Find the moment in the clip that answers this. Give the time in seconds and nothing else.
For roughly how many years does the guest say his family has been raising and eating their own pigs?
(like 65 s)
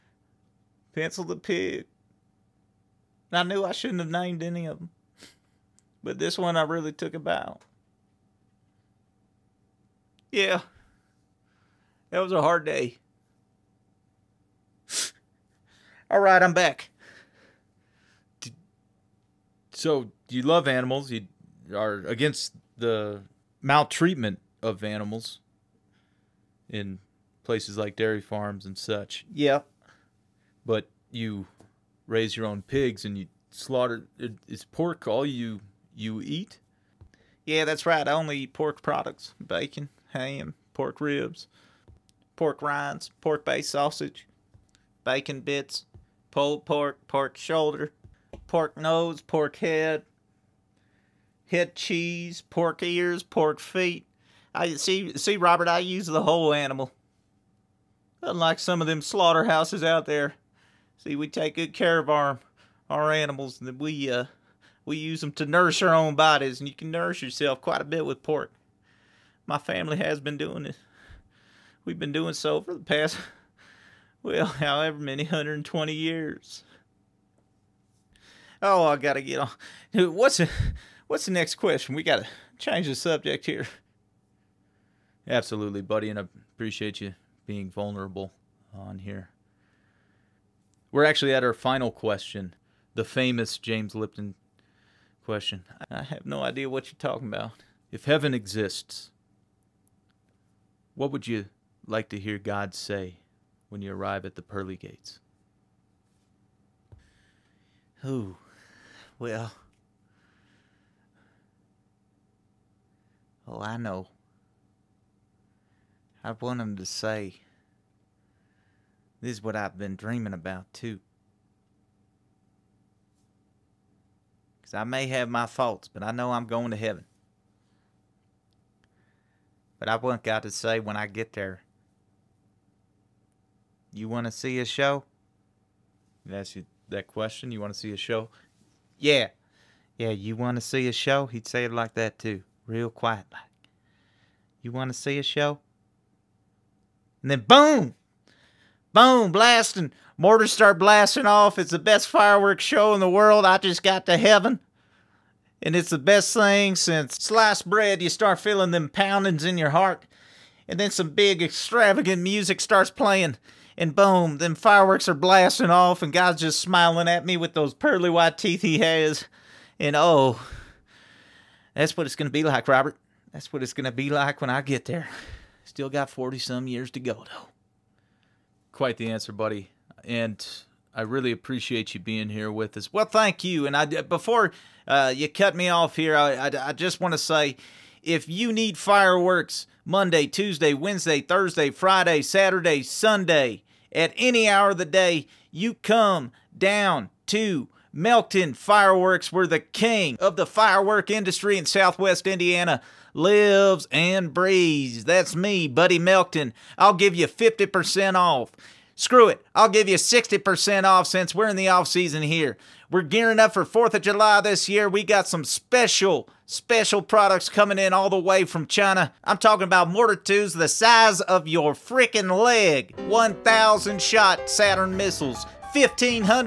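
75 s.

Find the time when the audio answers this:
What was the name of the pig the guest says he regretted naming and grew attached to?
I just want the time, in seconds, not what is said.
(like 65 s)
0 s.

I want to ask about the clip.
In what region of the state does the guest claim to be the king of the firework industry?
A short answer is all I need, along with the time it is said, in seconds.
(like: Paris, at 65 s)
Southwest Indiana, at 201 s.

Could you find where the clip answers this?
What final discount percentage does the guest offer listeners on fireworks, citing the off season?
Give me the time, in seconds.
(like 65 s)
209 s.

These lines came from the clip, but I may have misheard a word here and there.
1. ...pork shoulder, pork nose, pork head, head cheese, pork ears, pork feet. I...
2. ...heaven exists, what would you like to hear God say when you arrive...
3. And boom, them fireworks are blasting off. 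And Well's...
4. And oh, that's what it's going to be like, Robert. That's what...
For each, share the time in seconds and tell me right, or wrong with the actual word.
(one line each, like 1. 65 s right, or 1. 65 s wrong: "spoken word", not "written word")
1. 47 s right
2. 98 s right
3. 163 s wrong: "God", not "Well"
4. 169 s right.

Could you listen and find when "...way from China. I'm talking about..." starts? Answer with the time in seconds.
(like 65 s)
218 s.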